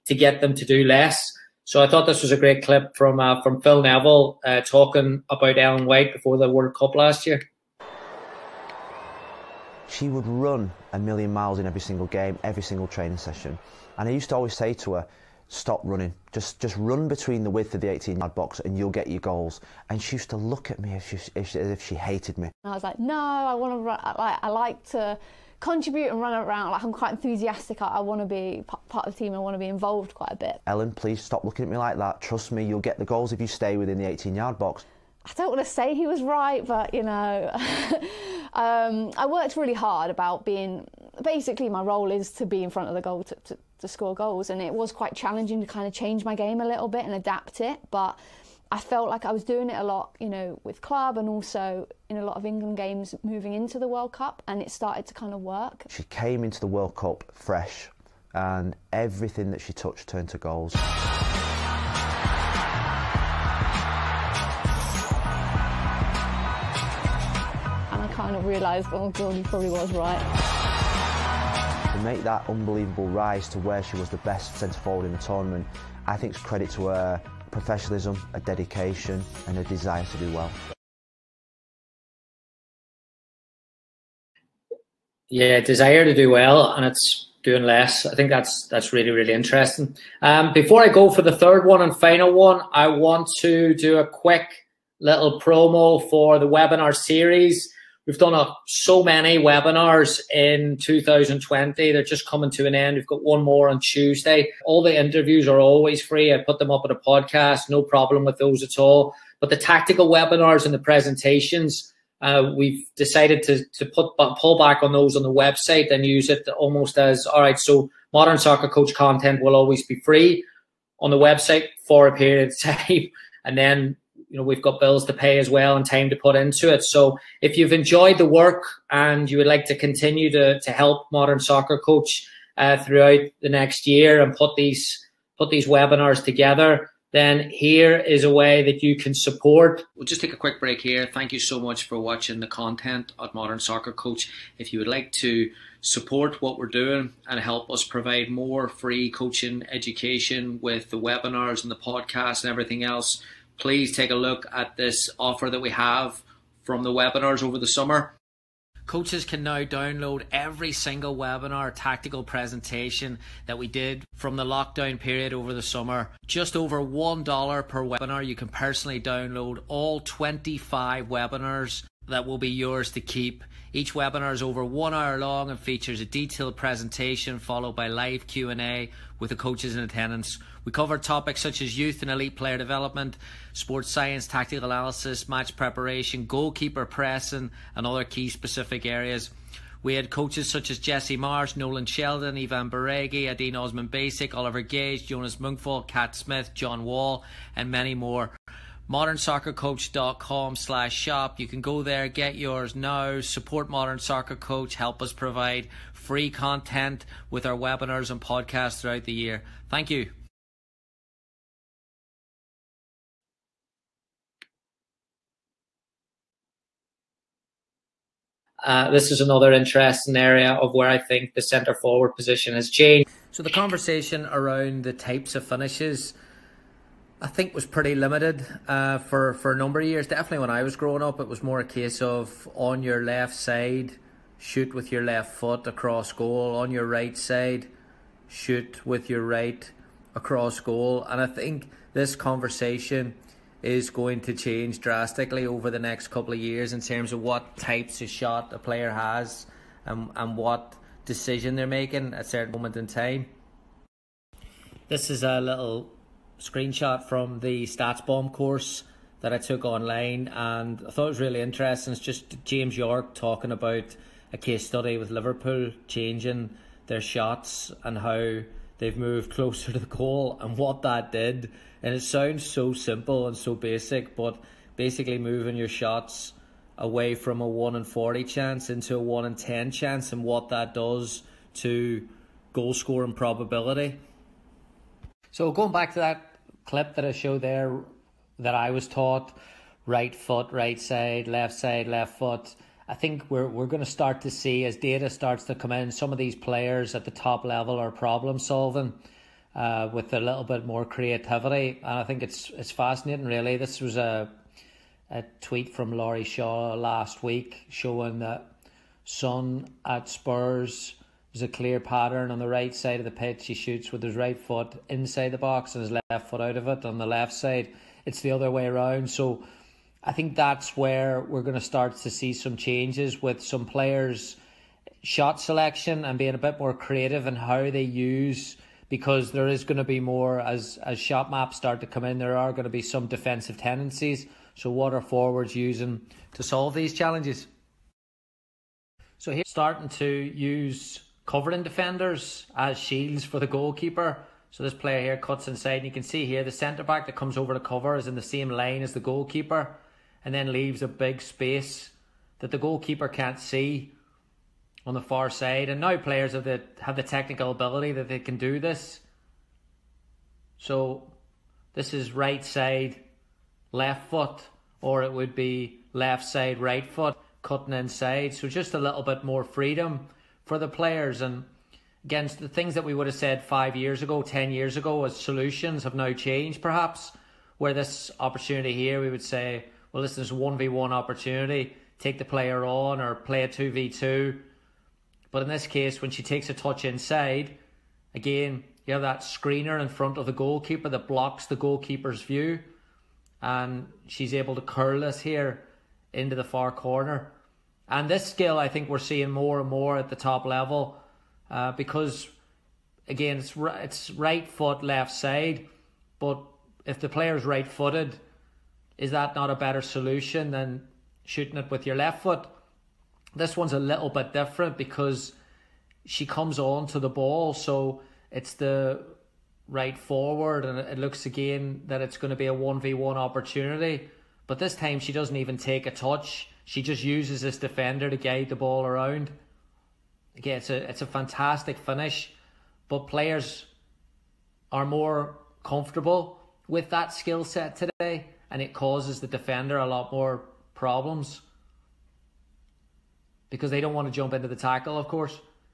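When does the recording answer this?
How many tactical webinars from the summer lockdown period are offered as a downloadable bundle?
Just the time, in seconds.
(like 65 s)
169 s.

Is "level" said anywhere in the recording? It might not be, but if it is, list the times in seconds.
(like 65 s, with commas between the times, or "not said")
297 s, 400 s.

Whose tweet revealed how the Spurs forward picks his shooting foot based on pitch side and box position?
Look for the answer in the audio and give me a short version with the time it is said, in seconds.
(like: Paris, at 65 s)
Laurie Shaw, at 305 s.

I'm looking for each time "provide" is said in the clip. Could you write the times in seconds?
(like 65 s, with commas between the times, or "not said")
147 s, 205 s.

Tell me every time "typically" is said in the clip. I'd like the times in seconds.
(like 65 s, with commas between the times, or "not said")
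not said.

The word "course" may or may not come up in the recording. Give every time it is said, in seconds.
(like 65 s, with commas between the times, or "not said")
258 s, 445 s.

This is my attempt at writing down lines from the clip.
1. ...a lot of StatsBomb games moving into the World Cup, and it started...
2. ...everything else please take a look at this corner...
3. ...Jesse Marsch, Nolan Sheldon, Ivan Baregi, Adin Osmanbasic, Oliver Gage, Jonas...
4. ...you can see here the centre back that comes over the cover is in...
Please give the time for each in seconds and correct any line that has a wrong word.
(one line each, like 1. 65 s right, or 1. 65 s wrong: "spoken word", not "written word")
1. 52 s wrong: "England", not "StatsBomb"
2. 152 s wrong: "offer", not "corner"
3. 190 s right
4. 345 s right.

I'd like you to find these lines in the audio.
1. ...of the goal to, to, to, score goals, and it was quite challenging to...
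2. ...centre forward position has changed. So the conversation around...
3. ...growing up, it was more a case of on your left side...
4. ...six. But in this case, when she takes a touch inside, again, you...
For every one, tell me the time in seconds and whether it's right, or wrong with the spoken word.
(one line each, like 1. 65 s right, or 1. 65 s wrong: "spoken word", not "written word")
1. 42 s right
2. 221 s right
3. 230 s right
4. 383 s wrong: "two", not "six".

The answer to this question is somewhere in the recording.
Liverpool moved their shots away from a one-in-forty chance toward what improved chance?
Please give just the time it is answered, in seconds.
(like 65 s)
278 s.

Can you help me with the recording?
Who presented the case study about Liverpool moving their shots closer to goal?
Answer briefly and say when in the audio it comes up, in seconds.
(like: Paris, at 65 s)
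James Yorke, at 262 s.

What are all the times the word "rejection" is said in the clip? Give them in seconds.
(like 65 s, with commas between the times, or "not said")
not said.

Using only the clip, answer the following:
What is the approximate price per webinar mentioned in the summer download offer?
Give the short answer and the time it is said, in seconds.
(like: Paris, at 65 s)
Just over $1, at 166 s.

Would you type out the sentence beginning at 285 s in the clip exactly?
So going back to that clip that I showed there that I was taught right foot, right side, left side, left foot.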